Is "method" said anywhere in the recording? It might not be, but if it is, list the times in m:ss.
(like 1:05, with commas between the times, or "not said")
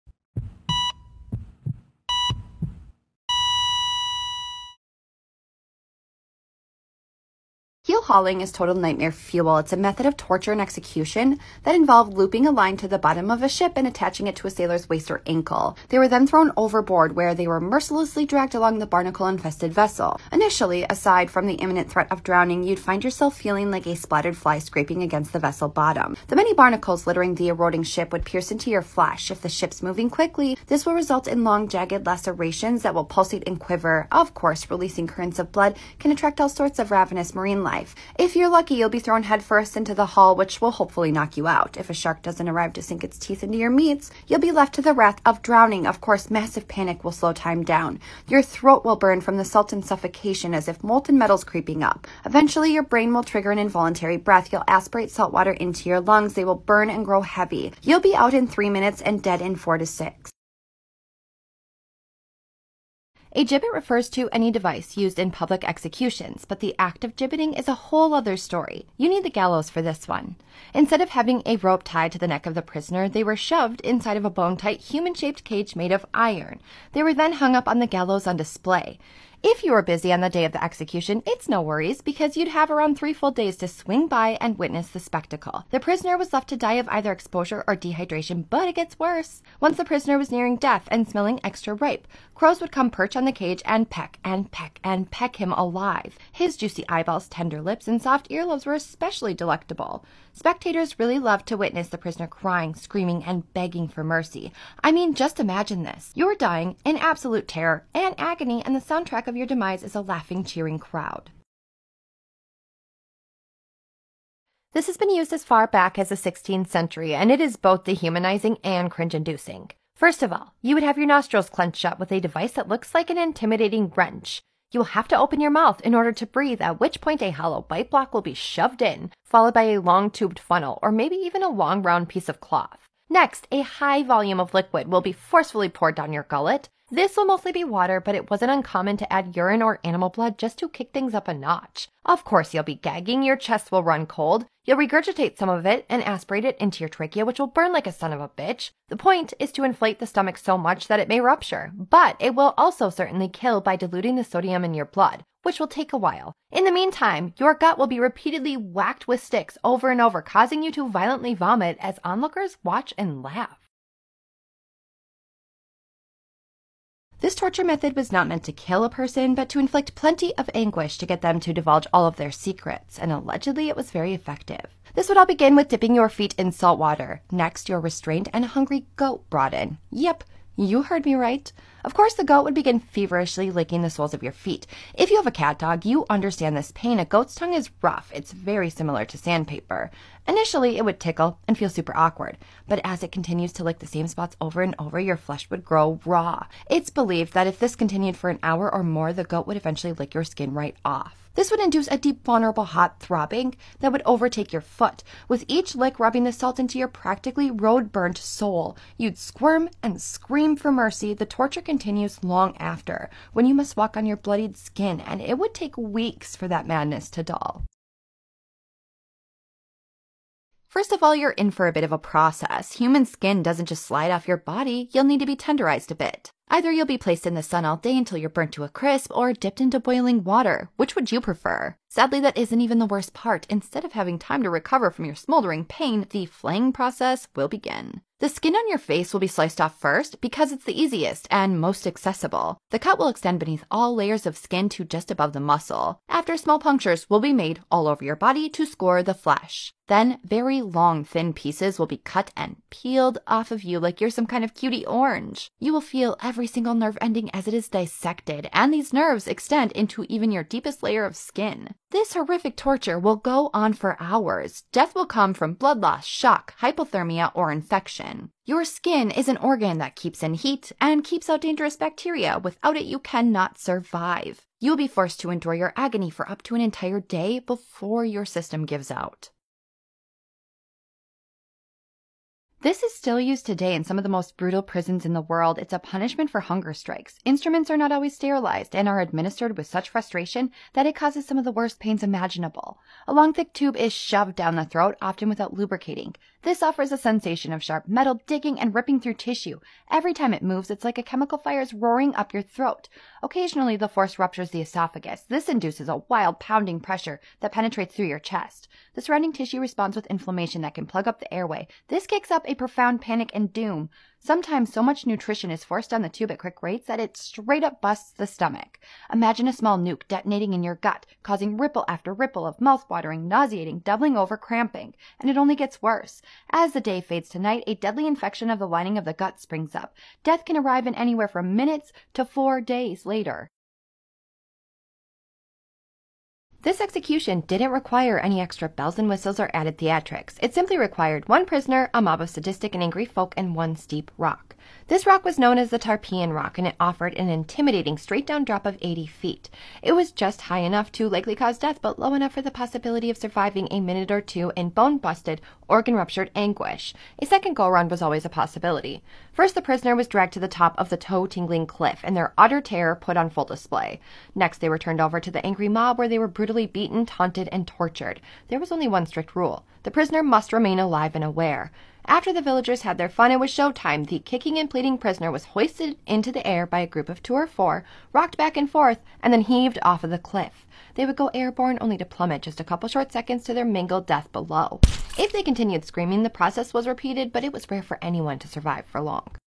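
0:09, 2:47.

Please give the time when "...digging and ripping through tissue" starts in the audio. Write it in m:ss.
4:58.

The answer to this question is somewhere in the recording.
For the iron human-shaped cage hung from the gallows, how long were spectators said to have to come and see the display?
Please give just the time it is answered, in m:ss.
1:22.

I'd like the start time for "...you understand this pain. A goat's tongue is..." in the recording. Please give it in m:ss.
3:05.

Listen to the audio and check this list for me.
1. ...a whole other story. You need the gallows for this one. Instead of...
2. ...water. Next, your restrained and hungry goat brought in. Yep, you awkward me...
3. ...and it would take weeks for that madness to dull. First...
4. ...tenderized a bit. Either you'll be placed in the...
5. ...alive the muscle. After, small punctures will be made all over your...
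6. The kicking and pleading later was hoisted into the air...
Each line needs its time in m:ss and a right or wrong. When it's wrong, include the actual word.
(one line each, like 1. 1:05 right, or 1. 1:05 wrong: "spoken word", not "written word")
1. 1:07 right
2. 2:56 wrong: "heard", not "awkward"
3. 3:34 right
4. 3:45 right
5. 4:05 wrong: "above", not "alive"
6. 6:14 wrong: "prisoner", not "later".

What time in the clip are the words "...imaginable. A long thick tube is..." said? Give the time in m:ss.
4:52.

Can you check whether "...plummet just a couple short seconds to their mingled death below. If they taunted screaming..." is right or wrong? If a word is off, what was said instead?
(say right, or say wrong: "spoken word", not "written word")
wrong: "continued", not "taunted".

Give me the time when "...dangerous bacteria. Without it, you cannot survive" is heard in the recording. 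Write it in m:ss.
4:31.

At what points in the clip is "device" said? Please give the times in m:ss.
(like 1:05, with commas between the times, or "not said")
1:04, 2:02.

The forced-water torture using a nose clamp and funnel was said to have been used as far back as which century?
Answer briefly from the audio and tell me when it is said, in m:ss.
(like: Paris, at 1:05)
16th century, at 1:56.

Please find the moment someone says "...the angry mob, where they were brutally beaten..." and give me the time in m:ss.
6:05.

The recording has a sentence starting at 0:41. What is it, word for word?
If a shark doesn't arrive to sink its teeth into your meats, you'll be left to the wrath of drowning.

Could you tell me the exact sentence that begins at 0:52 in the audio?
Eventually, your brain will trigger an involuntary breath.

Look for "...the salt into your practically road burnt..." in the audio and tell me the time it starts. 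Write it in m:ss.
3:26.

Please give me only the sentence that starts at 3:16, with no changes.
It's believed that if this continued for an hour or more, the goat would eventually lick your skin right off.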